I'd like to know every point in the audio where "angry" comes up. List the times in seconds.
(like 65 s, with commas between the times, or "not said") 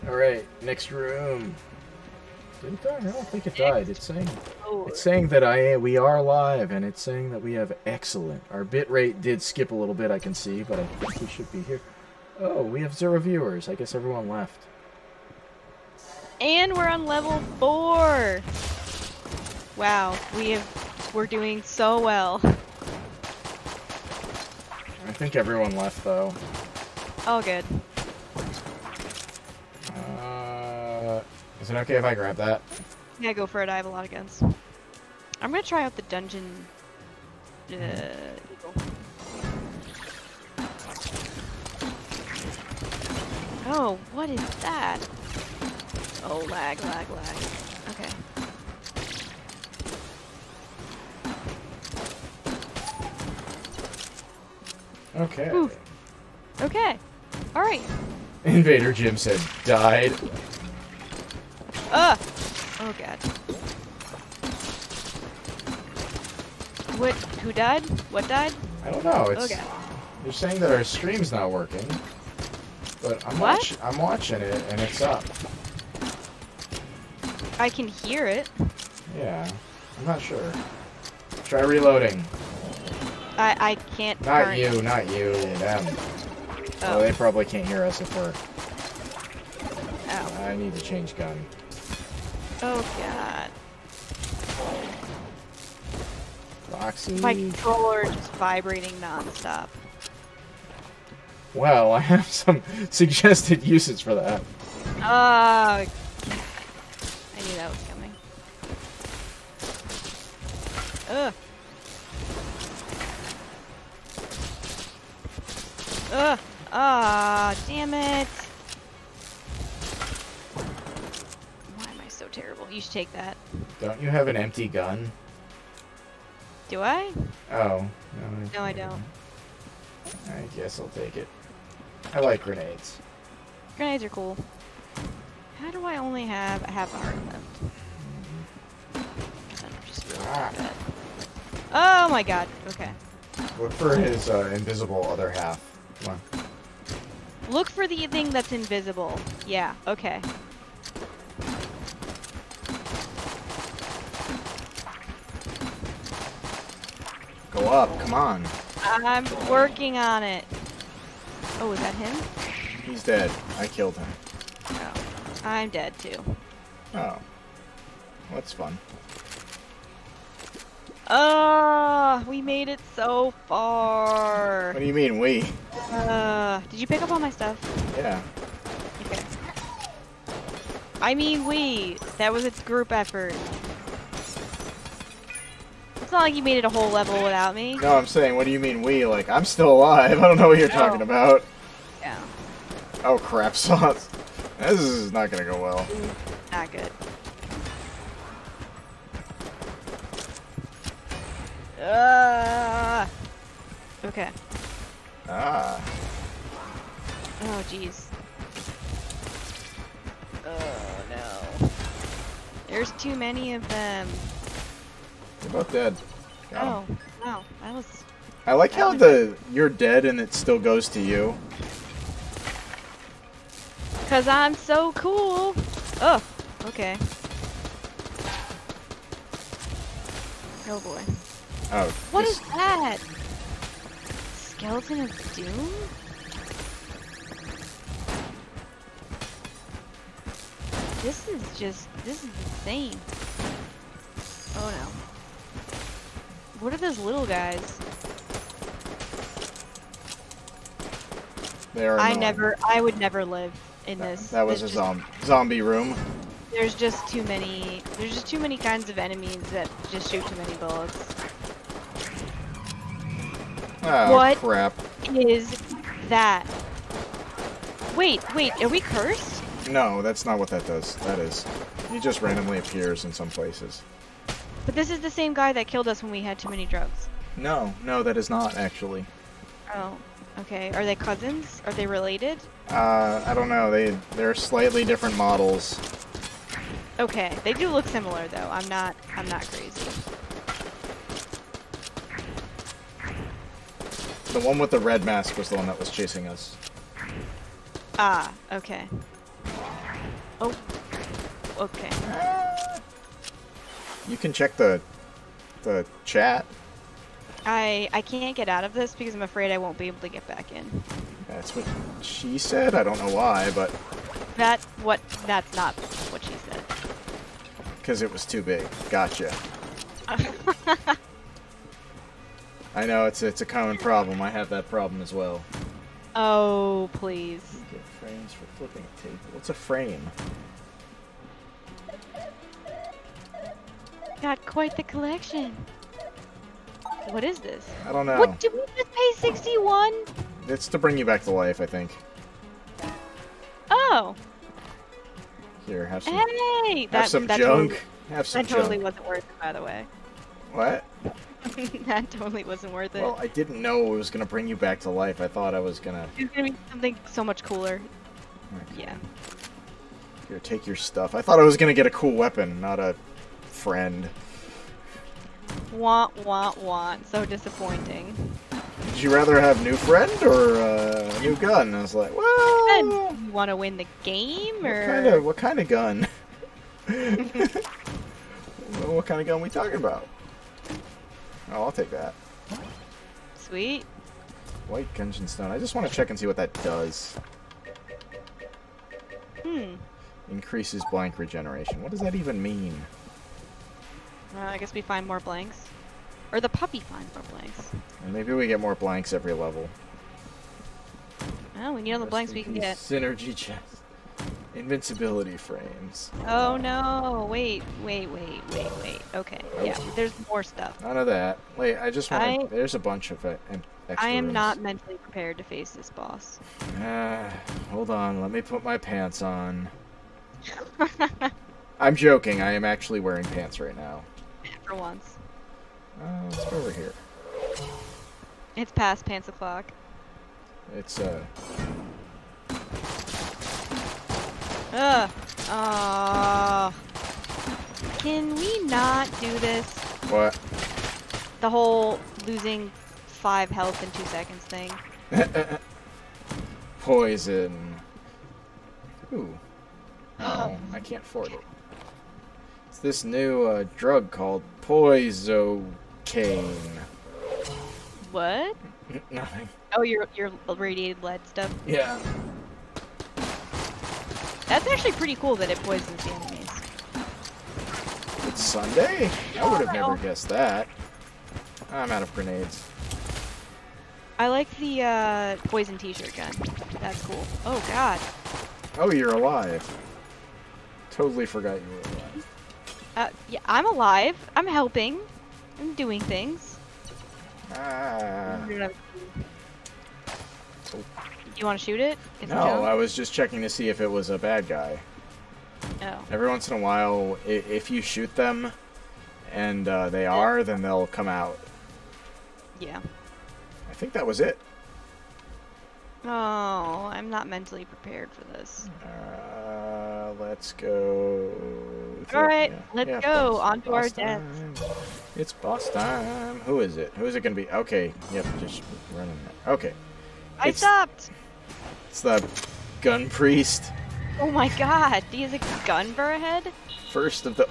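not said.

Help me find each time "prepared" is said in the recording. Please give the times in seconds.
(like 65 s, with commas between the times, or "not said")
414 s, 507 s.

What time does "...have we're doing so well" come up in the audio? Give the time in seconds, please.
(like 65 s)
20 s.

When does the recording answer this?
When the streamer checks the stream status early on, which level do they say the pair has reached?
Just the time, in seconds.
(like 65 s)
17 s.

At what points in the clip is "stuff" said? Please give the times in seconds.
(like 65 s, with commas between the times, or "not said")
177 s, 360 s, 410 s, 461 s.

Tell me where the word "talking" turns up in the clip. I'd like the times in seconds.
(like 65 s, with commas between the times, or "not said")
190 s, 379 s.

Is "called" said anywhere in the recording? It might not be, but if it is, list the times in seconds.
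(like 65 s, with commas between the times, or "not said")
454 s.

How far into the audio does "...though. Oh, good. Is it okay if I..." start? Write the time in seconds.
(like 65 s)
26 s.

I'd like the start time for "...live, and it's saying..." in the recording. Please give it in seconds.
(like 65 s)
6 s.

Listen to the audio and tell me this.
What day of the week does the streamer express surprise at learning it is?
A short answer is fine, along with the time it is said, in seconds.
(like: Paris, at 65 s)
Sunday, at 468 s.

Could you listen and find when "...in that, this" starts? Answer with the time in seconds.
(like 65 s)
253 s.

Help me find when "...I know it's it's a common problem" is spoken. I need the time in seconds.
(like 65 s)
322 s.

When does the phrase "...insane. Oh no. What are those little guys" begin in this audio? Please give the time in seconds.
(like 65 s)
242 s.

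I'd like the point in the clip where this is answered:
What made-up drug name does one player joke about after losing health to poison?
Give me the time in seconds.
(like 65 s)
454 s.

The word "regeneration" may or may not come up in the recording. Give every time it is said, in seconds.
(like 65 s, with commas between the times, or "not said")
391 s.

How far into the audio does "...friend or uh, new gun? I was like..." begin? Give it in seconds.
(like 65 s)
369 s.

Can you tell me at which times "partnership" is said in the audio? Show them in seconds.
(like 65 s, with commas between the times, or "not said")
not said.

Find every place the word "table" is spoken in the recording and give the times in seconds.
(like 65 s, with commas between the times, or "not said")
329 s.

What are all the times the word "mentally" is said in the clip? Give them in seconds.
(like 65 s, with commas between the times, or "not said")
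414 s, 507 s.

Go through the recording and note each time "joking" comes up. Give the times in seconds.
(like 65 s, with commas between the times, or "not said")
421 s.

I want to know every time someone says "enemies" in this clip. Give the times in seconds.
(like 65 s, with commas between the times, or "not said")
258 s, 466 s.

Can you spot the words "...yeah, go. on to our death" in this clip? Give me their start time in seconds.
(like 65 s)
512 s.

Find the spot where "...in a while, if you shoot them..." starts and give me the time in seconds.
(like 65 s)
496 s.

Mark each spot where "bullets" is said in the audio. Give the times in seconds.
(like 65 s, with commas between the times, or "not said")
260 s.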